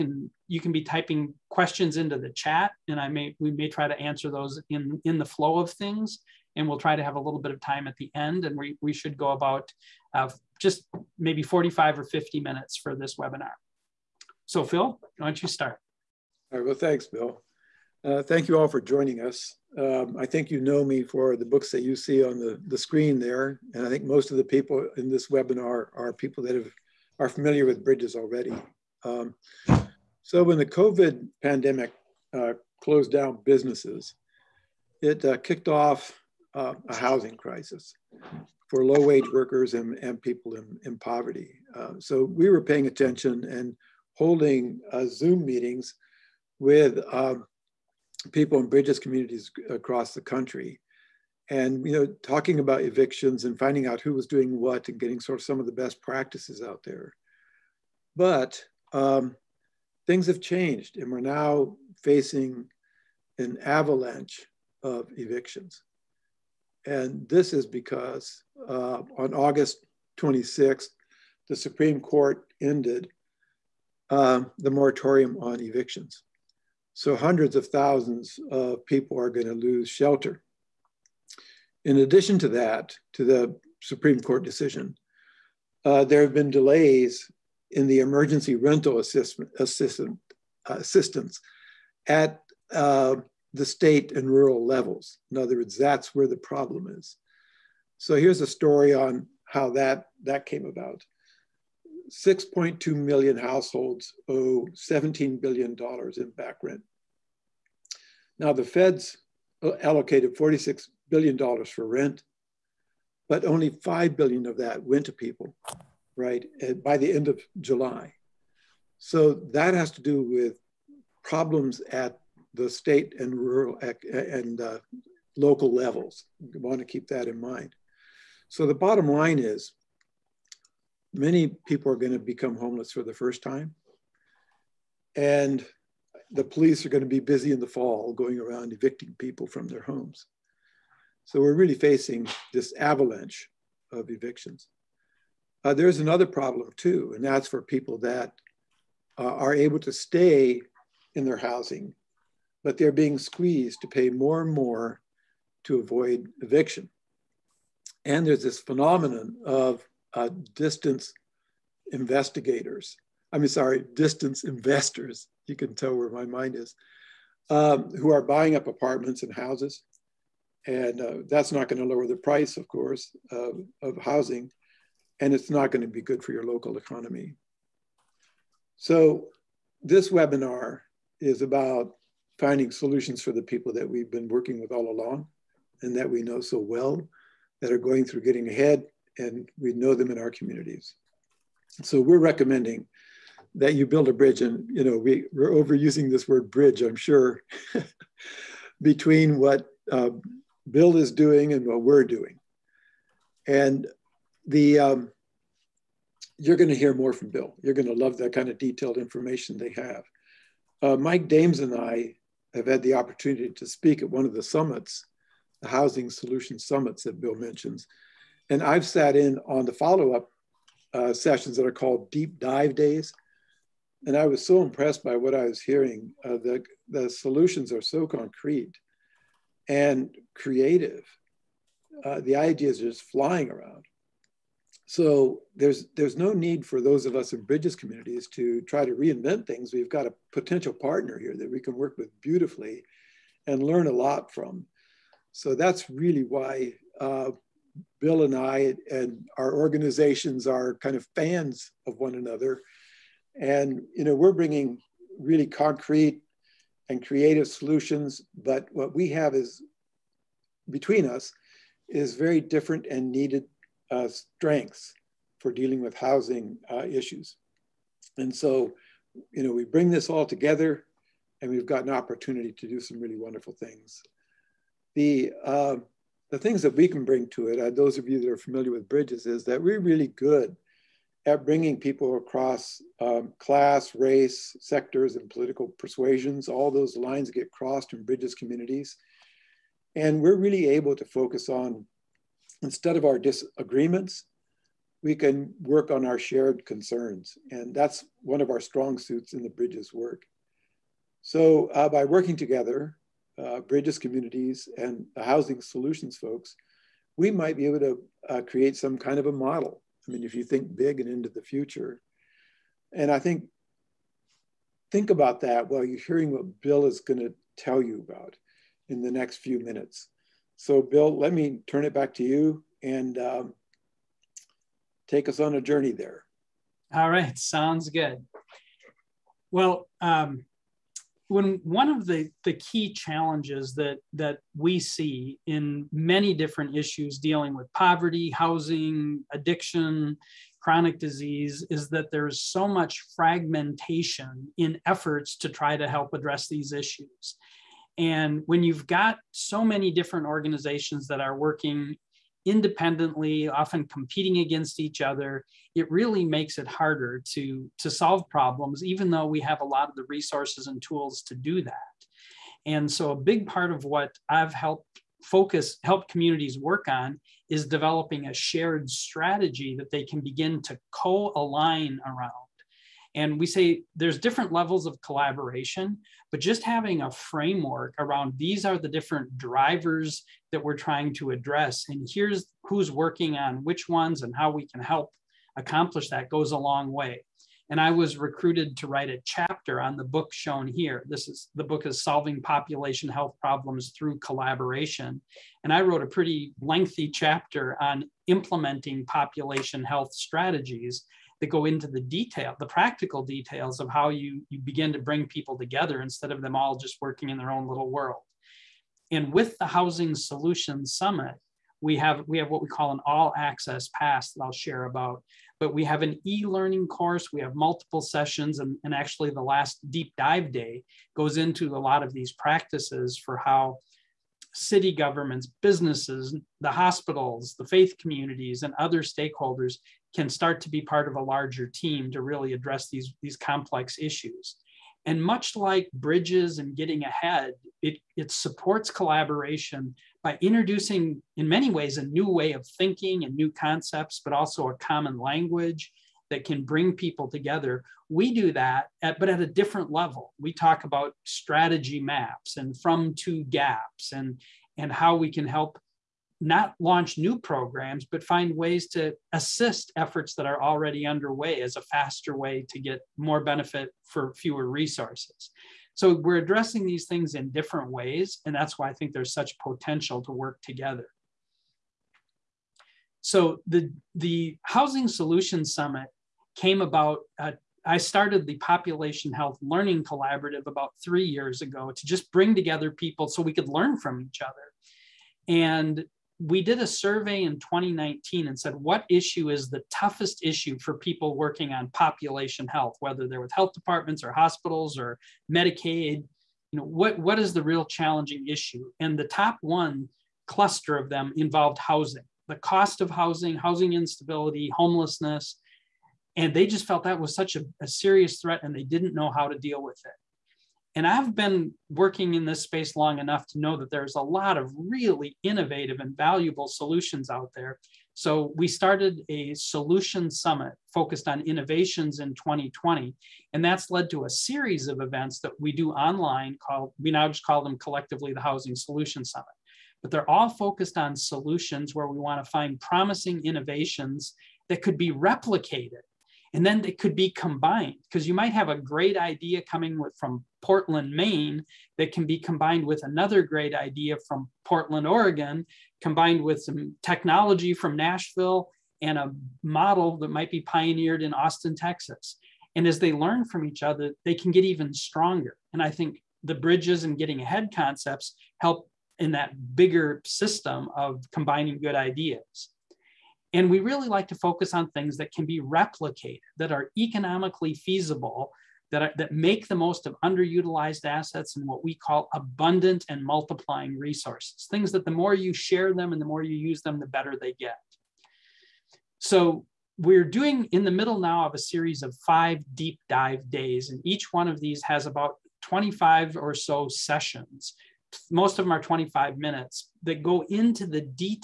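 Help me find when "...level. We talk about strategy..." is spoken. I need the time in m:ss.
7:29.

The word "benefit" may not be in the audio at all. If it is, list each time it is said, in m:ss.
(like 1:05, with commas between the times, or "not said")
7:43.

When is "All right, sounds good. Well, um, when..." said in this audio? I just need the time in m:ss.
5:26.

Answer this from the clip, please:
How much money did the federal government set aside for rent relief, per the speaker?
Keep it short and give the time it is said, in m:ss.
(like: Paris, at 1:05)
$46 billion, at 1:50.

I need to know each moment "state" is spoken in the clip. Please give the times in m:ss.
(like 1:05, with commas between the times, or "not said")
1:33, 2:02.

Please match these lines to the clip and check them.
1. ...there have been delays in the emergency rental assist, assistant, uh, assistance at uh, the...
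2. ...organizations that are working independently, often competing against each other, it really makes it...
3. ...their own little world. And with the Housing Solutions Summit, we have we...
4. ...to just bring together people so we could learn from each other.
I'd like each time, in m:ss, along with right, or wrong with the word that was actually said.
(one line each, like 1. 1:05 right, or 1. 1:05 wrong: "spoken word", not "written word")
1. 1:26 right
2. 5:50 right
3. 6:47 right
4. 8:01 right.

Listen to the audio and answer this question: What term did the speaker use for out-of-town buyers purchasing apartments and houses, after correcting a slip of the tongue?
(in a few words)
distance investors.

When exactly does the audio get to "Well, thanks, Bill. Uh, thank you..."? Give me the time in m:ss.
0:16.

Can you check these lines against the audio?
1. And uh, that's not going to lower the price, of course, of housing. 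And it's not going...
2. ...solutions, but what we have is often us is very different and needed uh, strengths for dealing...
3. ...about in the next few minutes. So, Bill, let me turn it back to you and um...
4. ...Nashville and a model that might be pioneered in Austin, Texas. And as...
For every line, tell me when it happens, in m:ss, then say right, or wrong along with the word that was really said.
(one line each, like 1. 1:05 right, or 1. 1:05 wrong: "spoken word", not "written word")
1. 2:50 right
2. 4:17 wrong: "between", not "often"
3. 5:18 right
4. 9:07 right.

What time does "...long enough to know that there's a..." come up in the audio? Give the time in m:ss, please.
8:32.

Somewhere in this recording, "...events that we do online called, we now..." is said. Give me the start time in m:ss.
8:45.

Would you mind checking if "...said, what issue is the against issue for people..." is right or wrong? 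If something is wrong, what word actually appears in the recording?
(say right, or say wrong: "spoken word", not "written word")
wrong: "toughest", not "against".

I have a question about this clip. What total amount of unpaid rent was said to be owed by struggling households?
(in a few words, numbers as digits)
$17 billion.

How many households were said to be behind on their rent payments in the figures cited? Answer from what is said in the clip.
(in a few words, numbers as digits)
6.2 million.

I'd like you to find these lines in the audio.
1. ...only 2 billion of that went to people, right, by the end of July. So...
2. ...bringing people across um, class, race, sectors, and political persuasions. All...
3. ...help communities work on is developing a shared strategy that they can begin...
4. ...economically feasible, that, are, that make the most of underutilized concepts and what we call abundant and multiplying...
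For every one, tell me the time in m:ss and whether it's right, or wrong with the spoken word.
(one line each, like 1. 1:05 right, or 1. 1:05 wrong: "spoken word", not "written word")
1. 1:53 wrong: "5", not "2"
2. 4:41 right
3. 6:05 right
4. 9:26 wrong: "assets", not "concepts".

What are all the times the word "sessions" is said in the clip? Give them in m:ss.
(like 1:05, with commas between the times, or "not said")
3:41, 6:58, 9:46.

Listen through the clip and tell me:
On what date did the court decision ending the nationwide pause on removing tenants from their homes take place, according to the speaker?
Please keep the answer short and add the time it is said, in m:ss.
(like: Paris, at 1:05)
August 26th, at 1:09.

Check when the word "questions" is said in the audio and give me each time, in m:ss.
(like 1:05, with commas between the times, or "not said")
0:01.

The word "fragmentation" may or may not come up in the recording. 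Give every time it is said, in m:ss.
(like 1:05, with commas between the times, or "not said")
5:43.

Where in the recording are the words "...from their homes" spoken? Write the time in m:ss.
2:19.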